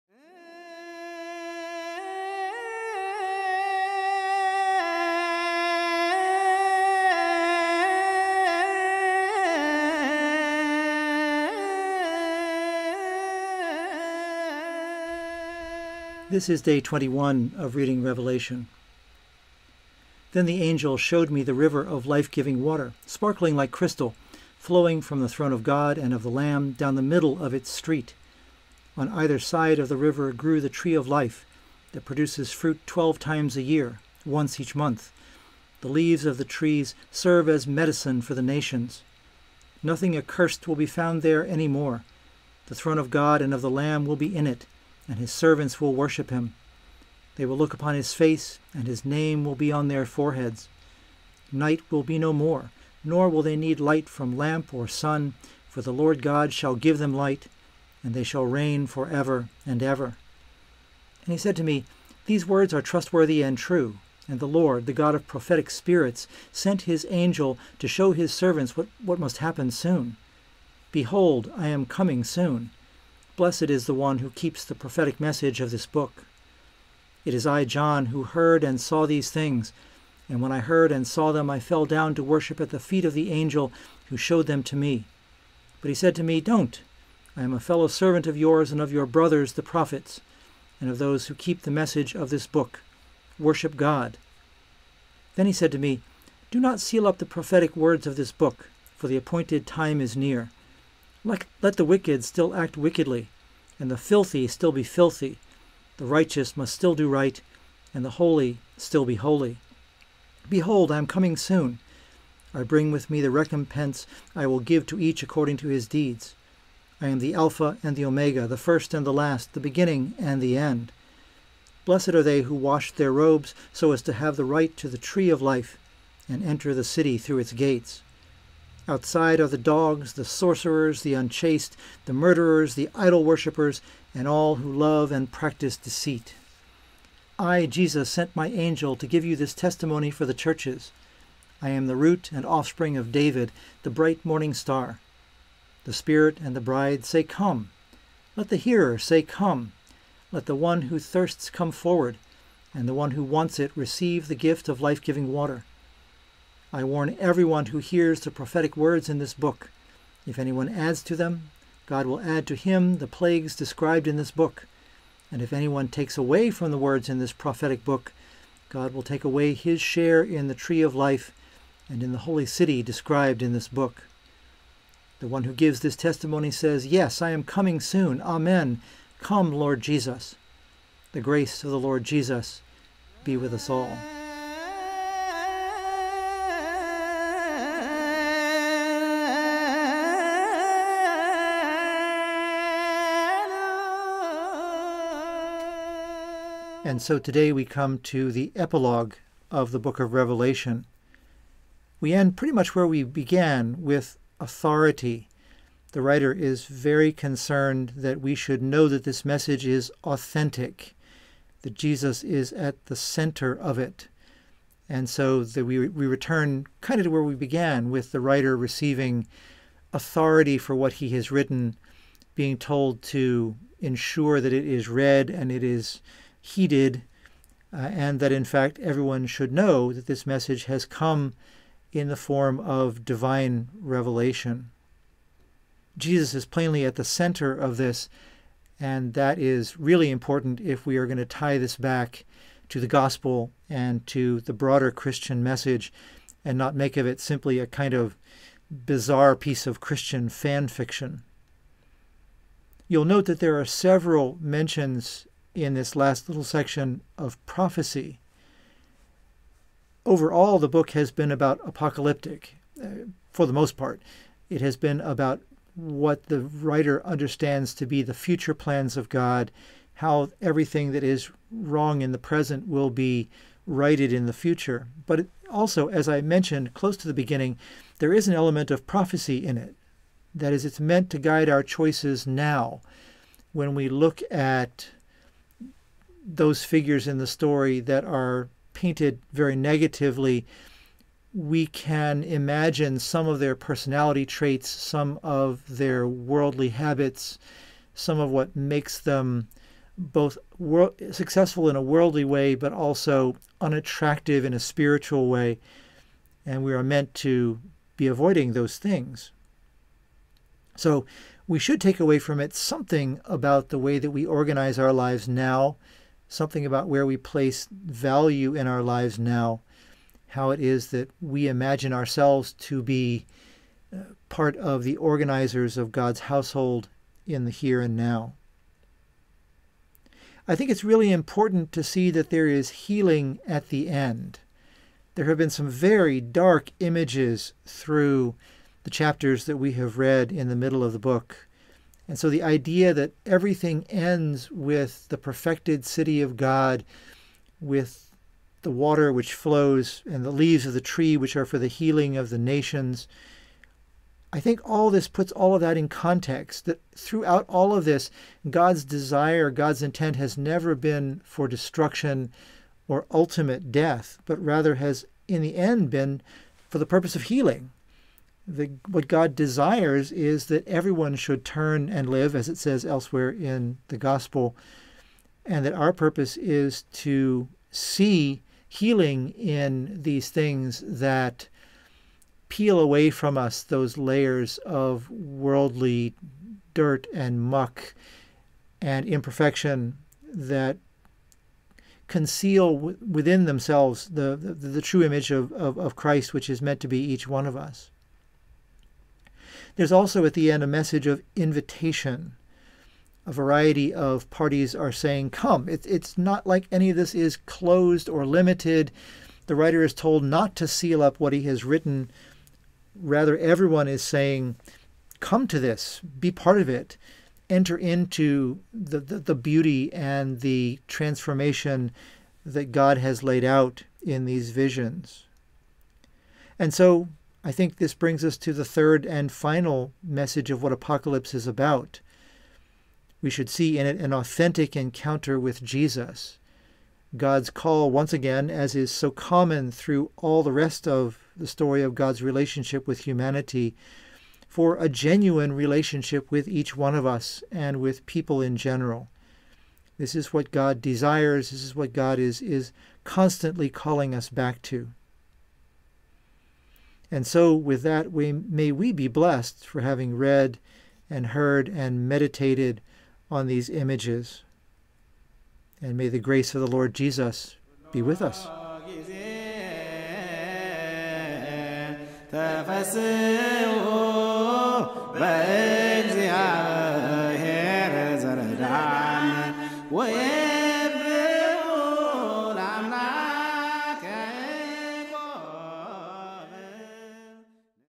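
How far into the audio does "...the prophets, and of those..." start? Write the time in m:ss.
1:29.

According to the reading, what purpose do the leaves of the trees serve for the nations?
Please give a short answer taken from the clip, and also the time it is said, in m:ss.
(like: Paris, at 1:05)
medicine, at 0:37.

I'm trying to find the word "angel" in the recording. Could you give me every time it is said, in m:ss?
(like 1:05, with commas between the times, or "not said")
0:20, 1:07, 1:23, 2:18.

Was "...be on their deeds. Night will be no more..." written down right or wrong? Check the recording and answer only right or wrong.
wrong.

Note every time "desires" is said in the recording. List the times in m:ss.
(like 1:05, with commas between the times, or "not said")
5:58, 6:09, 7:30.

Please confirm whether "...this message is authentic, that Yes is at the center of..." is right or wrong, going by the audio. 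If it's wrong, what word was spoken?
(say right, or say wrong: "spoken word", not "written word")
wrong: "Jesus", not "Yes".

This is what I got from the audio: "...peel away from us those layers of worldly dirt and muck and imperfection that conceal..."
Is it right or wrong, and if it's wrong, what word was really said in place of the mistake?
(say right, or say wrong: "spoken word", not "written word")
right.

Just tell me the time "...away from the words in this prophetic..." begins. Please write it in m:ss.
2:46.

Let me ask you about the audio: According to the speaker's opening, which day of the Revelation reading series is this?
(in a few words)
21.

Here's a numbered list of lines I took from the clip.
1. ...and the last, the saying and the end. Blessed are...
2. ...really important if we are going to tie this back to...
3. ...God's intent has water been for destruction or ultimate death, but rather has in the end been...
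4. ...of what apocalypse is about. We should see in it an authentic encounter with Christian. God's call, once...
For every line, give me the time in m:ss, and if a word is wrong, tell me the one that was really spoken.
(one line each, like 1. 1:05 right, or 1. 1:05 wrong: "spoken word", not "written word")
1. 1:58 wrong: "beginning", not "saying"
2. 3:59 right
3. 5:59 wrong: "never", not "water"
4. 7:10 wrong: "Jesus", not "Christian".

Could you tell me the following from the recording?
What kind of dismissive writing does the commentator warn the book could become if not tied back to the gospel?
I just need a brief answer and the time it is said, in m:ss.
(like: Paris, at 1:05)
Christian fan fiction, at 4:09.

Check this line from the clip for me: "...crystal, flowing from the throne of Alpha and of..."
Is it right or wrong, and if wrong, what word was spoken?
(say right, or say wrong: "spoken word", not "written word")
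wrong: "God", not "Alpha".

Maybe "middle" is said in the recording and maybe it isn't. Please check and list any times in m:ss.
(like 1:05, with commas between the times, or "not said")
0:27, 5:40.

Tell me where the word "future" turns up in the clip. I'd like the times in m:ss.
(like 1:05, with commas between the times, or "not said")
4:28, 4:34.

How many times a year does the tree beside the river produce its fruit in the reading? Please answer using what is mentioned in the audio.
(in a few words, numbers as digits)
12.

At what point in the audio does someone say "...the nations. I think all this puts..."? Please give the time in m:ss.
5:52.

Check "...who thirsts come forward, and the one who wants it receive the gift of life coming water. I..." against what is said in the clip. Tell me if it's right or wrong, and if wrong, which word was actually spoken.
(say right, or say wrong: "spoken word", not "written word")
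wrong: "giving", not "coming".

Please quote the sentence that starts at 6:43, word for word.
A variety of parties are saying, Come.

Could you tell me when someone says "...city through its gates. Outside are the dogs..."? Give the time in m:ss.
2:06.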